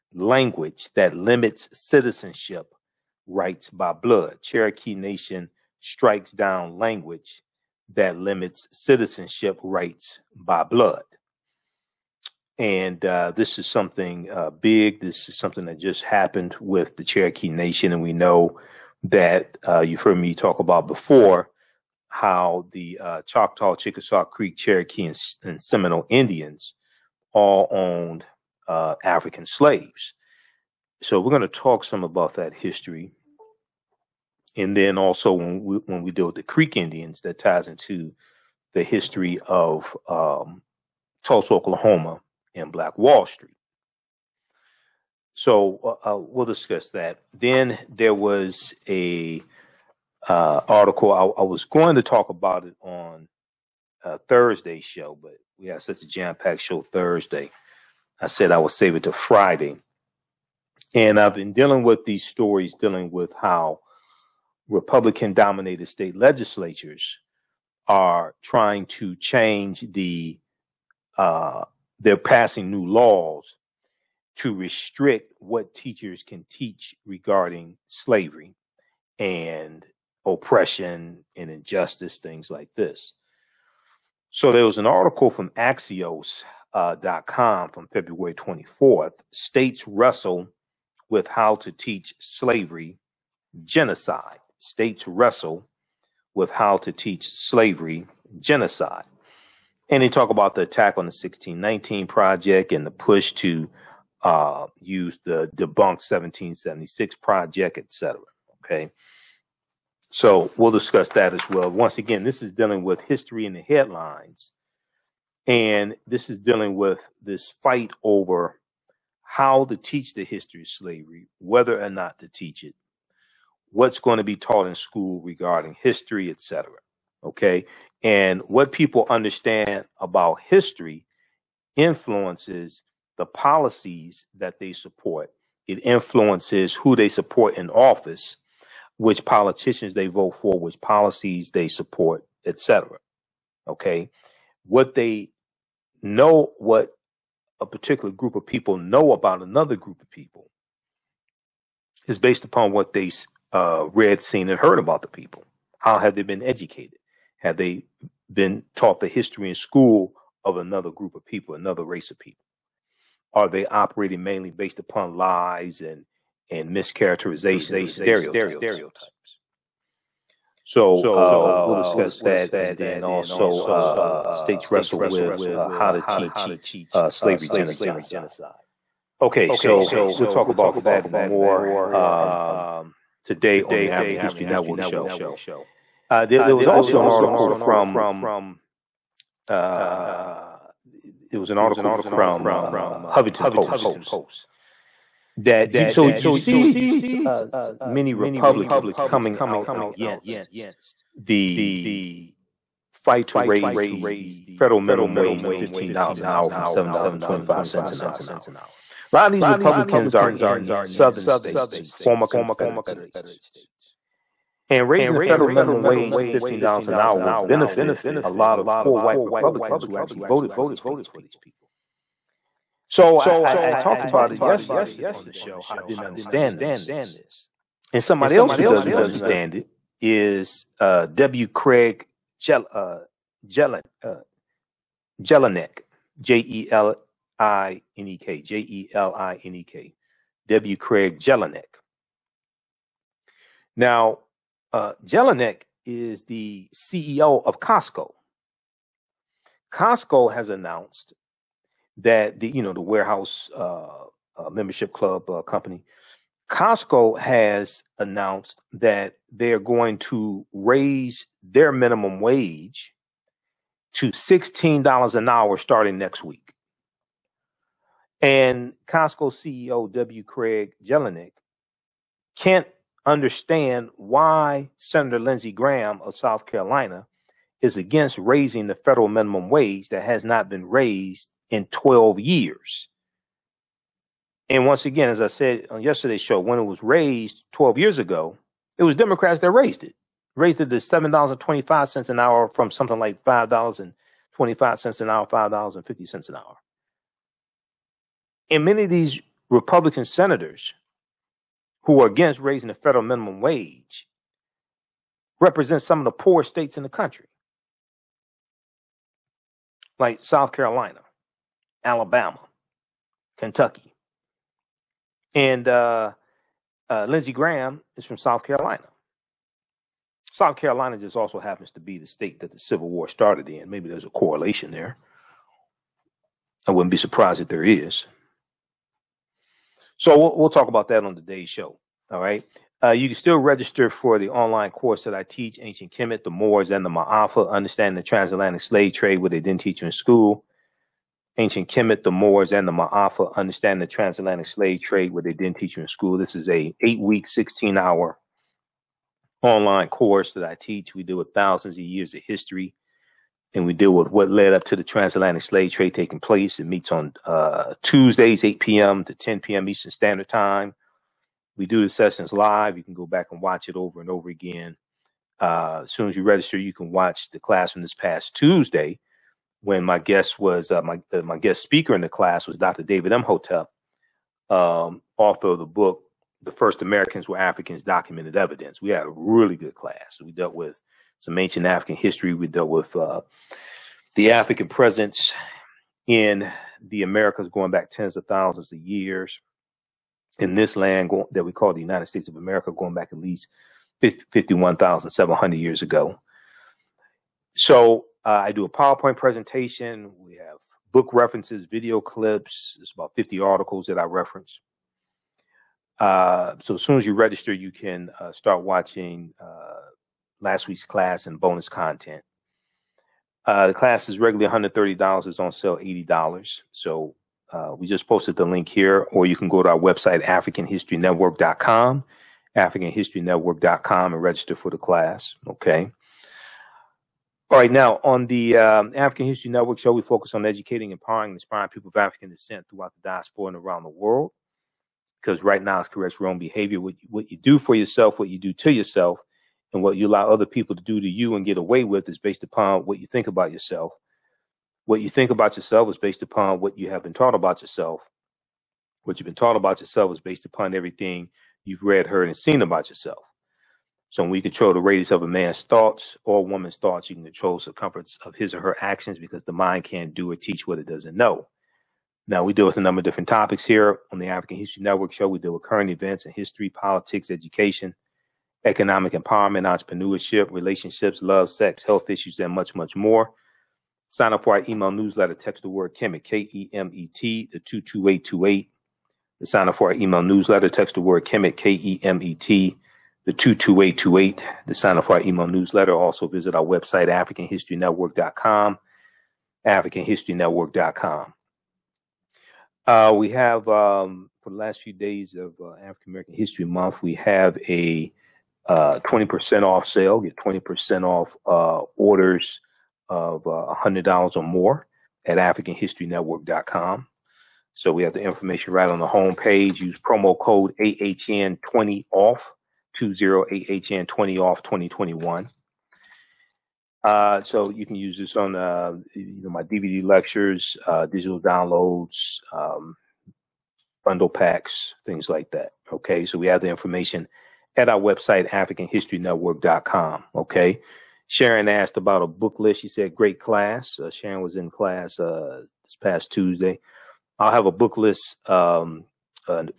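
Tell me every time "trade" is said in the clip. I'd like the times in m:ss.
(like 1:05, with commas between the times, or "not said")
5:38, 5:44, 5:55.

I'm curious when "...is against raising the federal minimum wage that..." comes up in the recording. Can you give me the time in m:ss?
4:37.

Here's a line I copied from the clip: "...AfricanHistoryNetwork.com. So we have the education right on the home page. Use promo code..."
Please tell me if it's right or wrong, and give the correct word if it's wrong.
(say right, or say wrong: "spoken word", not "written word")
wrong: "information", not "education".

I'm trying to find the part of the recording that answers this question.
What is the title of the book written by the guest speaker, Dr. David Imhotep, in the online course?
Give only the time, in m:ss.
6:16.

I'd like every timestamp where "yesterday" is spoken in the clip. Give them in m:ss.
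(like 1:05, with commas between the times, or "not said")
3:44, 4:45.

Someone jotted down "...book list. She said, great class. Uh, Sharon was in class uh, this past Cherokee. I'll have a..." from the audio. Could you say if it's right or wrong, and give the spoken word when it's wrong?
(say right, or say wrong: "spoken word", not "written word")
wrong: "Tuesday", not "Cherokee".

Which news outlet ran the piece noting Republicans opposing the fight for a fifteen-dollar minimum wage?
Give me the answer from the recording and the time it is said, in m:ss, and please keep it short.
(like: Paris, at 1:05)
Huffington Post, at 3:13.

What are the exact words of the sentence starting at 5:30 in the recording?
So we'll, we'll talk about that on today's show.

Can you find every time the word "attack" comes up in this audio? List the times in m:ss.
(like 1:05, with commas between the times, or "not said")
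1:40.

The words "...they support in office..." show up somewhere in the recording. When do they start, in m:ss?
2:16.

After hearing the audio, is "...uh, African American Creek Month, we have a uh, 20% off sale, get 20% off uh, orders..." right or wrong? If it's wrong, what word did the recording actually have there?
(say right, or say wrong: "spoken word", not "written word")
wrong: "History", not "Creek".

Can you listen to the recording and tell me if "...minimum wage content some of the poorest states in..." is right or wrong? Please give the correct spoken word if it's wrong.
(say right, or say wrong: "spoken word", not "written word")
wrong: "represent", not "content".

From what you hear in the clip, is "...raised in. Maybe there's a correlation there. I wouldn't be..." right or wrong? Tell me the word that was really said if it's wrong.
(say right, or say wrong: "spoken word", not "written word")
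wrong: "started", not "raised".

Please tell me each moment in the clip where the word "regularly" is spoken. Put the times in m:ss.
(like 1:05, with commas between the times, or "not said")
6:54.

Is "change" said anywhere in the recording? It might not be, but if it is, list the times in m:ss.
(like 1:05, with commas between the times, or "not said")
1:09.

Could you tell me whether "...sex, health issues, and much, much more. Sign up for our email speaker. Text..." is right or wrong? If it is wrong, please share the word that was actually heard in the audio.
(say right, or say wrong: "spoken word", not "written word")
wrong: "newsletter", not "speaker".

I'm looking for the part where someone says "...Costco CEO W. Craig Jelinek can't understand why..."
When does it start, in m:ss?
4:28.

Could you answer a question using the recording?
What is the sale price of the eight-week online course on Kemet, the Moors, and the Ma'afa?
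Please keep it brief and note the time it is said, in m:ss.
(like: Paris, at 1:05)
$80, at 6:55.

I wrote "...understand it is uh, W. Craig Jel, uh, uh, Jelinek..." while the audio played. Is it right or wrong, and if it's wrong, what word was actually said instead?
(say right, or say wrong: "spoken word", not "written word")
right.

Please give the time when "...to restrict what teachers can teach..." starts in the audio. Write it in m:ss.
1:14.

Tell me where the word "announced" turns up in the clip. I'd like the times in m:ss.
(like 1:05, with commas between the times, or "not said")
4:10, 4:17.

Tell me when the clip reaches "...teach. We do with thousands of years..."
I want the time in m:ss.
5:50.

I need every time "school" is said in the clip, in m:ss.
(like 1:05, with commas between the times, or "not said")
2:04, 2:39, 5:39, 5:45.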